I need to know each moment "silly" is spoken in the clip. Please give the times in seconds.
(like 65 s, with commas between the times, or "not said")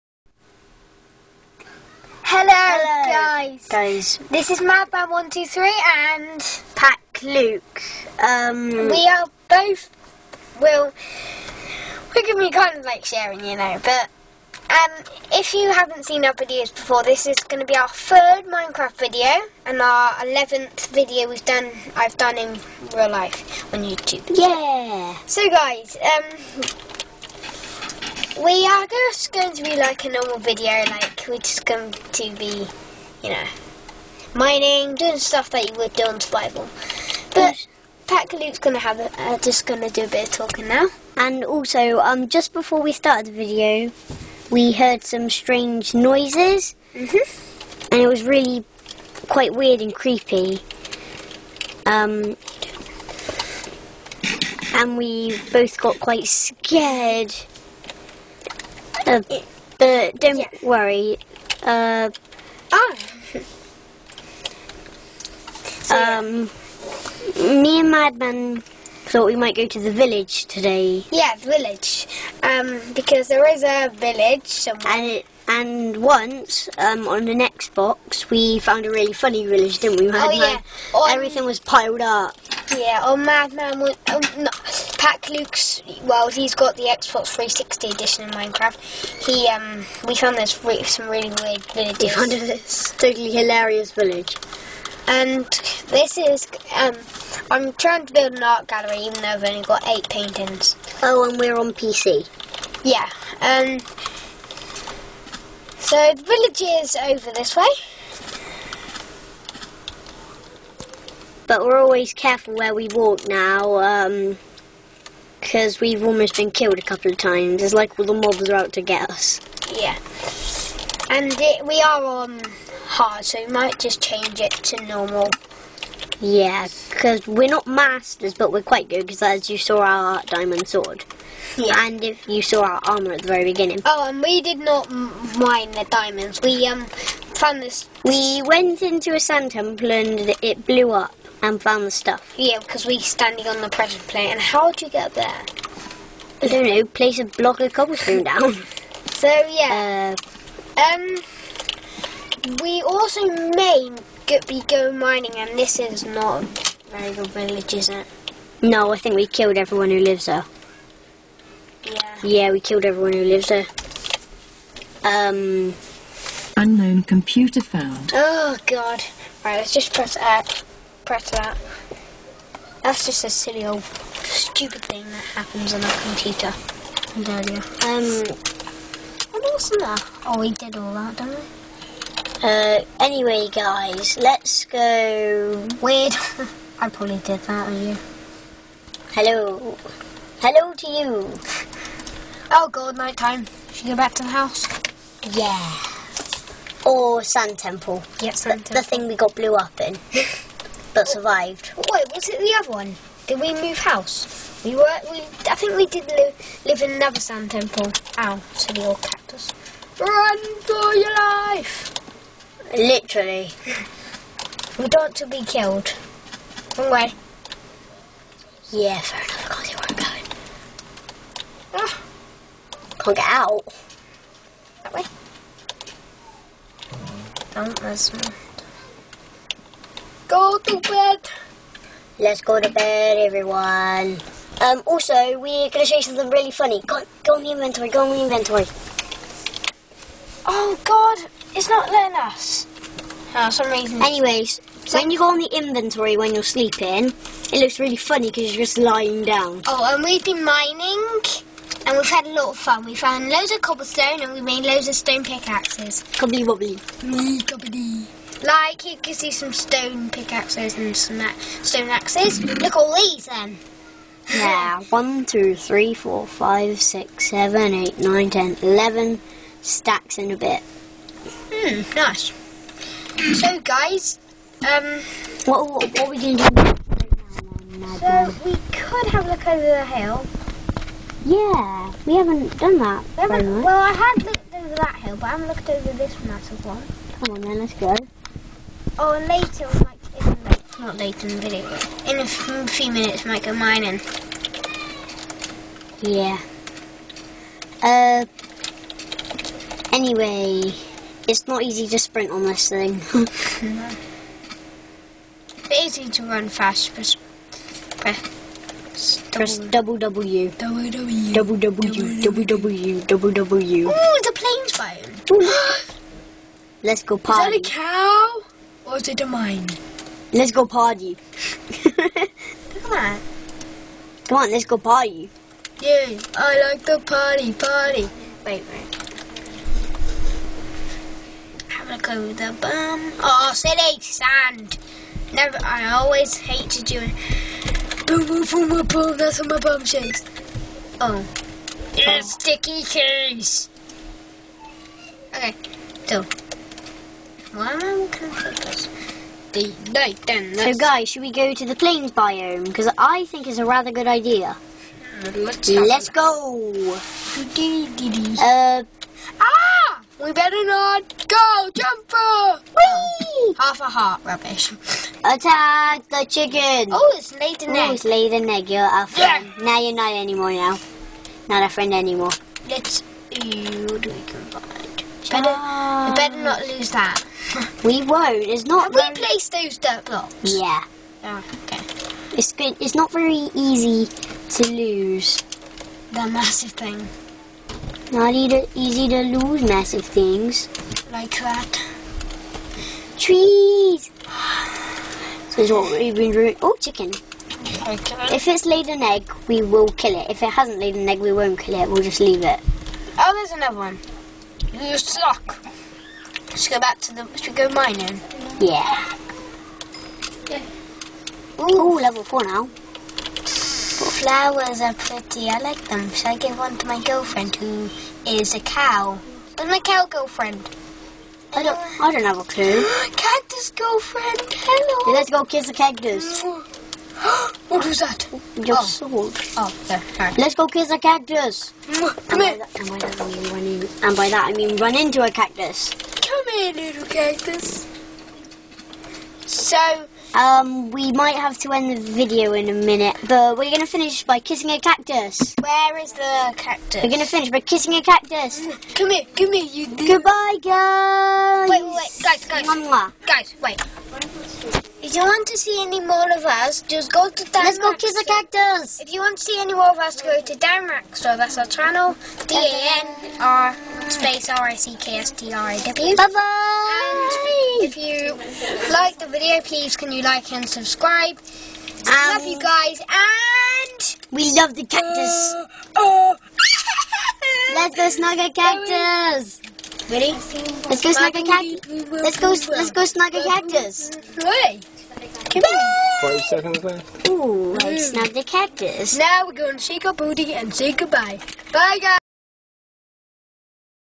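173 s, 333 s.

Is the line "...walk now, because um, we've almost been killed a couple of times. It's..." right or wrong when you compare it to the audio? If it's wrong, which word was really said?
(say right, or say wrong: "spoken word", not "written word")
right.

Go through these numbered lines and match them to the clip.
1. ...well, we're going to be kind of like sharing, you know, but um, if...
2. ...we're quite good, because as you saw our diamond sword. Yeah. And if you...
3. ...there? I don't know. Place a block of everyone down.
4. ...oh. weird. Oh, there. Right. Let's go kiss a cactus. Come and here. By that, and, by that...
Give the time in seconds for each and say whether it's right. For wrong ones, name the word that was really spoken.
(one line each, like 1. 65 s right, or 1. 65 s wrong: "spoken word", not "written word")
1. 10 s right
2. 128 s right
3. 145 s wrong: "cobblestone", not "everyone"
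4. 428 s wrong: "sword", not "weird".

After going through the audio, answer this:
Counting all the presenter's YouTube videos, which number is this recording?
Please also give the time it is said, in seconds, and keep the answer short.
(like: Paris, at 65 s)
11th, at 20 s.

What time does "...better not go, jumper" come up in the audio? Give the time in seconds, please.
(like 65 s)
360 s.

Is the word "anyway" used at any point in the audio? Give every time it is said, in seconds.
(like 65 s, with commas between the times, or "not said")
182 s, 244 s, 299 s.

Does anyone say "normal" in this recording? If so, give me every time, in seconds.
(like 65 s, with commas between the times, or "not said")
30 s, 124 s.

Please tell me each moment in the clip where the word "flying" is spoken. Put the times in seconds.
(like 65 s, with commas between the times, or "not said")
314 s.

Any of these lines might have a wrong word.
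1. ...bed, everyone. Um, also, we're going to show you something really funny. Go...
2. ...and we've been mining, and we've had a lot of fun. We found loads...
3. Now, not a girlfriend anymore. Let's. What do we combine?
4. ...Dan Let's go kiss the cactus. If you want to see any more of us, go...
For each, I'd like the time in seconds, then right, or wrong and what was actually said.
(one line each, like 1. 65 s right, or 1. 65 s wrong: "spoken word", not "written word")
1. 232 s right
2. 249 s right
3. 370 s wrong: "friend", not "girlfriend"
4. 457 s right.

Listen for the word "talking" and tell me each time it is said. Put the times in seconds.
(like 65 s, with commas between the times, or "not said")
40 s.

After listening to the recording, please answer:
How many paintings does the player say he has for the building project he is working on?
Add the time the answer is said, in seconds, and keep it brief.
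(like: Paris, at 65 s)
8, at 99 s.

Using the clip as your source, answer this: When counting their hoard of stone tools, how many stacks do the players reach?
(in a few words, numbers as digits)
11.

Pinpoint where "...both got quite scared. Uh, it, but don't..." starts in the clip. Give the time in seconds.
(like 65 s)
55 s.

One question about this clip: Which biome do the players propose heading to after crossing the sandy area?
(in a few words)
plains biome.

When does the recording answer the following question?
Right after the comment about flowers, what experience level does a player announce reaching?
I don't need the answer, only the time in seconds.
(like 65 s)
411 s.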